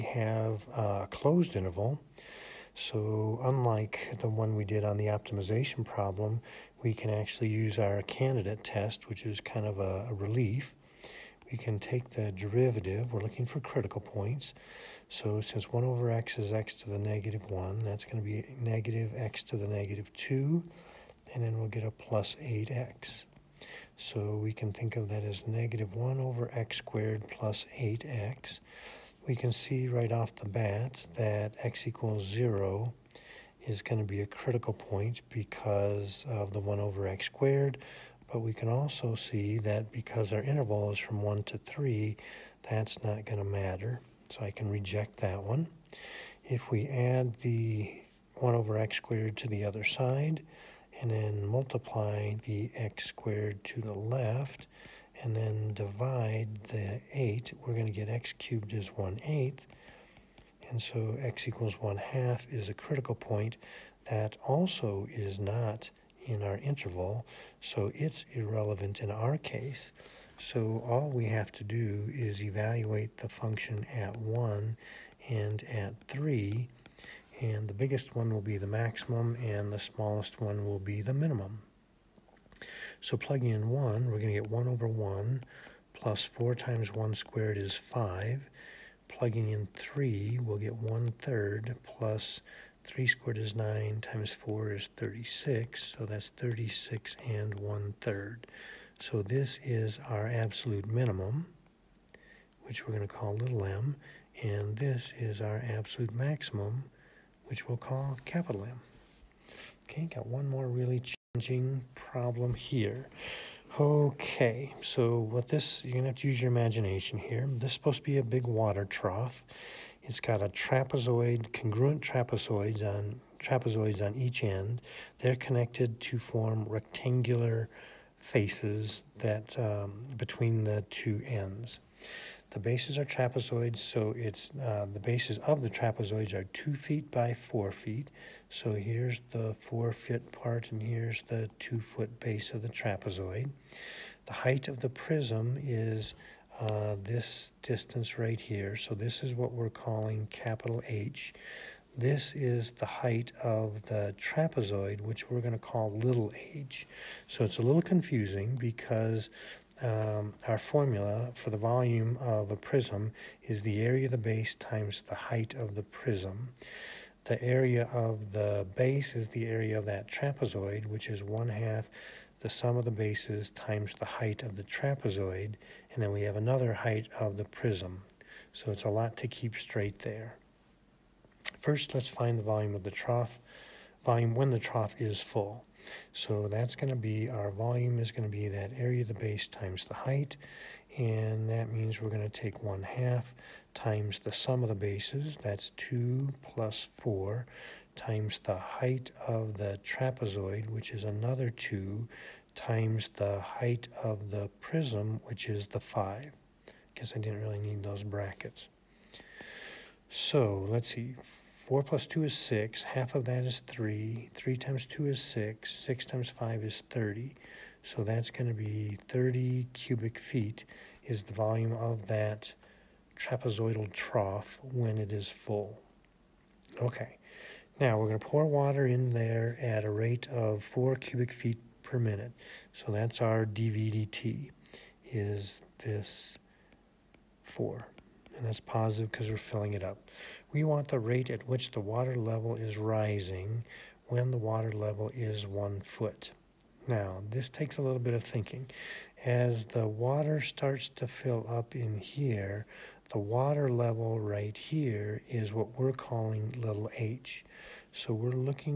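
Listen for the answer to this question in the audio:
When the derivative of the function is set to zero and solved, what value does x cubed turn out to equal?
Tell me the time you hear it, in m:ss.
0:58.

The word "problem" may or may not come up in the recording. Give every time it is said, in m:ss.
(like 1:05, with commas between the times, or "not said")
0:05, 1:51.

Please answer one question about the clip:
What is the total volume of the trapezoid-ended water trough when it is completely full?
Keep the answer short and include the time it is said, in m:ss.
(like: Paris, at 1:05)
30 cubic feet, at 3:39.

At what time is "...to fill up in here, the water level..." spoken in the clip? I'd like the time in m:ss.
4:10.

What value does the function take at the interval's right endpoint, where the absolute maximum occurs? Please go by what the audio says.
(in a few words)
36 1/3.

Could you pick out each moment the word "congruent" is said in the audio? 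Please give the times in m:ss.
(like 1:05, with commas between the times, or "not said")
2:01.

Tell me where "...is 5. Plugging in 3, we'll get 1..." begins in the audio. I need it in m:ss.
1:27.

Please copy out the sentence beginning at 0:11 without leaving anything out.
We can take the derivative, we're looking for critical points.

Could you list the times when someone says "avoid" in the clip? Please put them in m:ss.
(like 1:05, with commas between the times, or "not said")
not said.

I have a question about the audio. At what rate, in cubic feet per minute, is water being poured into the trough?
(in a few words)
4.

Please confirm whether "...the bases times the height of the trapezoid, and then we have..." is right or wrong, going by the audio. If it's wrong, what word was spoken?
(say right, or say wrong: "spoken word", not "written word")
right.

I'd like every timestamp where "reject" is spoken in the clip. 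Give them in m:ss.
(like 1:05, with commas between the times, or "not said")
0:44.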